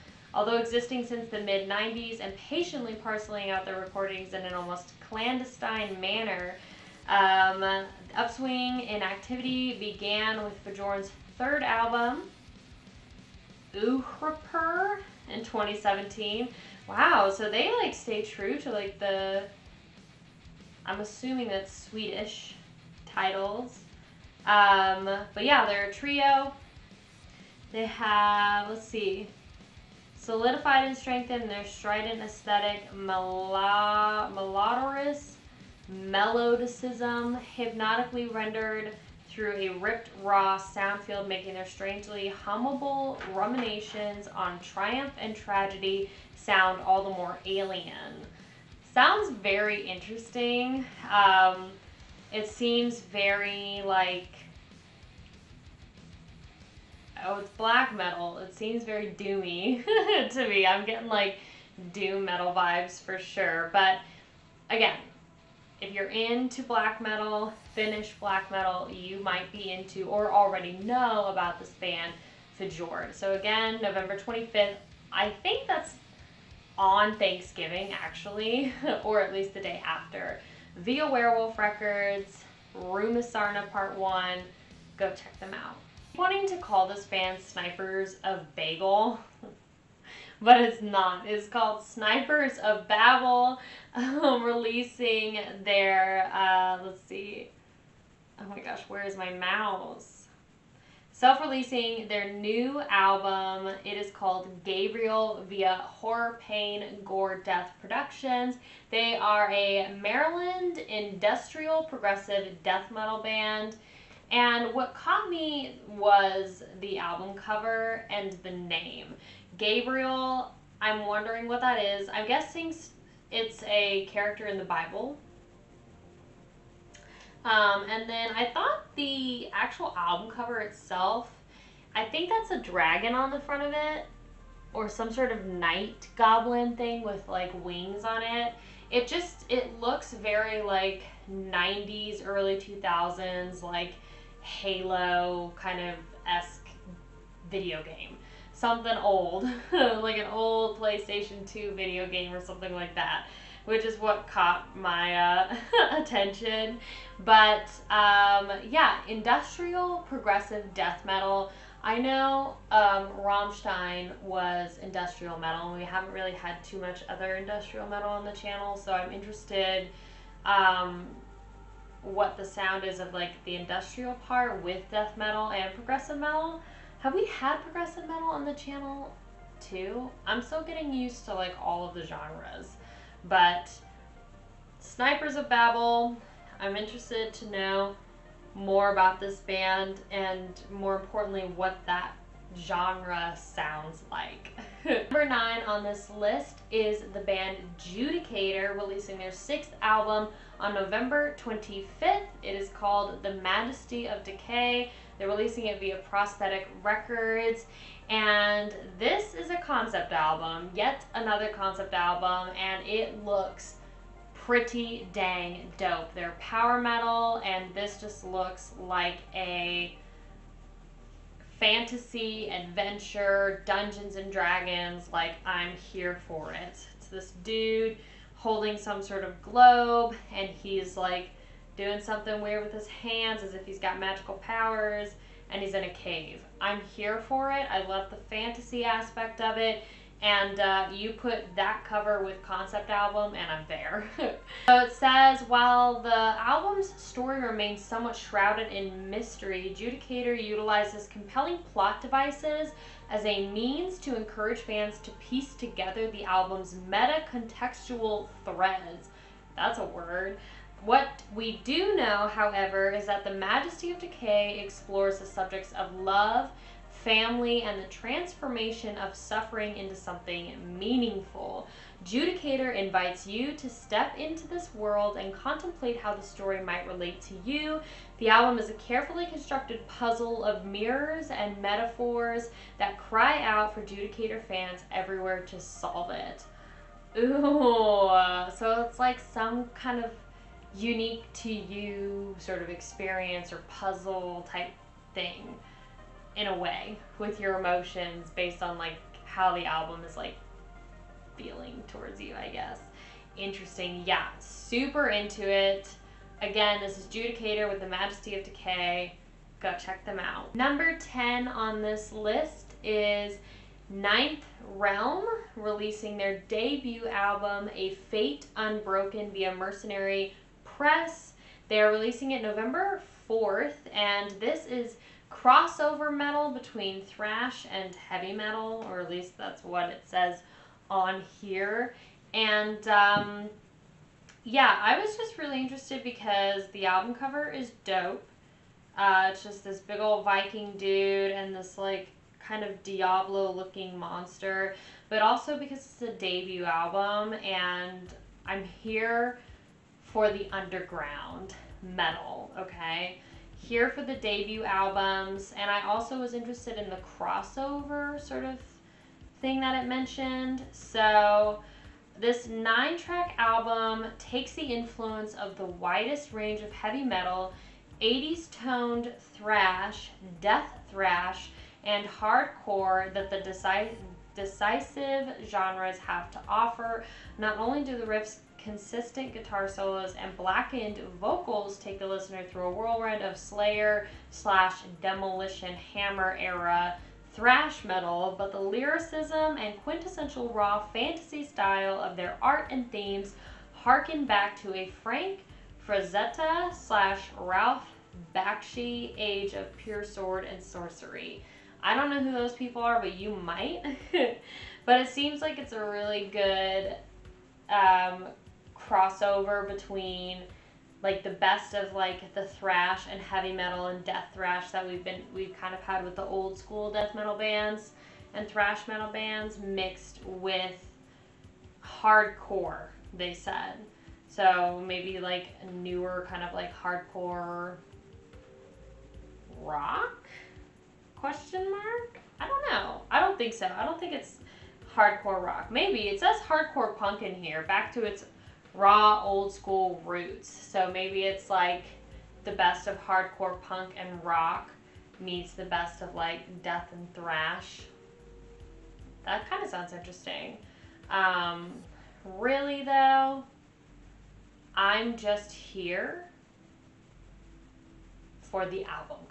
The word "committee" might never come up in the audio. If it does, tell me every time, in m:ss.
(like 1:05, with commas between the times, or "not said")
not said.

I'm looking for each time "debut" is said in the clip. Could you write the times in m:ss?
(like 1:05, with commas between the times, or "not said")
5:16, 5:46, 5:54.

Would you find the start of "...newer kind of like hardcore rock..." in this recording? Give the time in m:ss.
7:05.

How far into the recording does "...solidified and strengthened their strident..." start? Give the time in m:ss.
0:30.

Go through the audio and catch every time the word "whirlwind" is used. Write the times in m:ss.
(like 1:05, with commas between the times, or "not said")
6:22.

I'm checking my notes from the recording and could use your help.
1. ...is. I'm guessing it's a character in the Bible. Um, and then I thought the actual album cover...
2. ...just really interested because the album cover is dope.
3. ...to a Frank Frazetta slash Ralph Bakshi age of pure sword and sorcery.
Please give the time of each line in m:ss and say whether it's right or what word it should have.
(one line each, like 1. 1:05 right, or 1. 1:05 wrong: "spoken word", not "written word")
1. 2:01 right
2. 5:35 right
3. 6:34 right.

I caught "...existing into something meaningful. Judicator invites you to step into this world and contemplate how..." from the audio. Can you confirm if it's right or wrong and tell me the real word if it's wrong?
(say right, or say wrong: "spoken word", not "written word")
wrong: "suffering", not "existing".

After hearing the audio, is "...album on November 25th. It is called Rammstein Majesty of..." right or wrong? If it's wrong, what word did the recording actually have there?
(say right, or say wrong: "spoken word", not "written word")
wrong: "The", not "Rammstein".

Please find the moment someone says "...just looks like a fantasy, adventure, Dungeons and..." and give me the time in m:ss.
3:37.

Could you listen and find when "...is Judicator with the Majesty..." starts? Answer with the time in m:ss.
5:06.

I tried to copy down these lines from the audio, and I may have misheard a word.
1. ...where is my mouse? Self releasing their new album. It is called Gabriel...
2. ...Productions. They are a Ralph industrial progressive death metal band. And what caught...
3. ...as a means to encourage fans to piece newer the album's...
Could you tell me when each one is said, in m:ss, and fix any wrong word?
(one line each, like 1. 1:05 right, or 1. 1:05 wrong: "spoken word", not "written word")
1. 1:38 right
2. 1:47 wrong: "Maryland", not "Ralph"
3. 4:13 wrong: "together", not "newer".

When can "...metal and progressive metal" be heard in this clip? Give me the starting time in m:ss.
2:55.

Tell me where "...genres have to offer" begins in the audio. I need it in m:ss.
6:15.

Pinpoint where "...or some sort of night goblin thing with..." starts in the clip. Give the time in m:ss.
2:14.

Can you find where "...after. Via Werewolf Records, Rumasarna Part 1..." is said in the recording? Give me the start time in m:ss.
1:19.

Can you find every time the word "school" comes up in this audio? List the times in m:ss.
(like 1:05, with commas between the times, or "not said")
6:56, 7:19.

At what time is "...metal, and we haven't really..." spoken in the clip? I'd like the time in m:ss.
2:45.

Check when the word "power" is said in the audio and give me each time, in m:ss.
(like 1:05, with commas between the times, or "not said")
3:36, 3:54.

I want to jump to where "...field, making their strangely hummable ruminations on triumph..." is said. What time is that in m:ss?
0:40.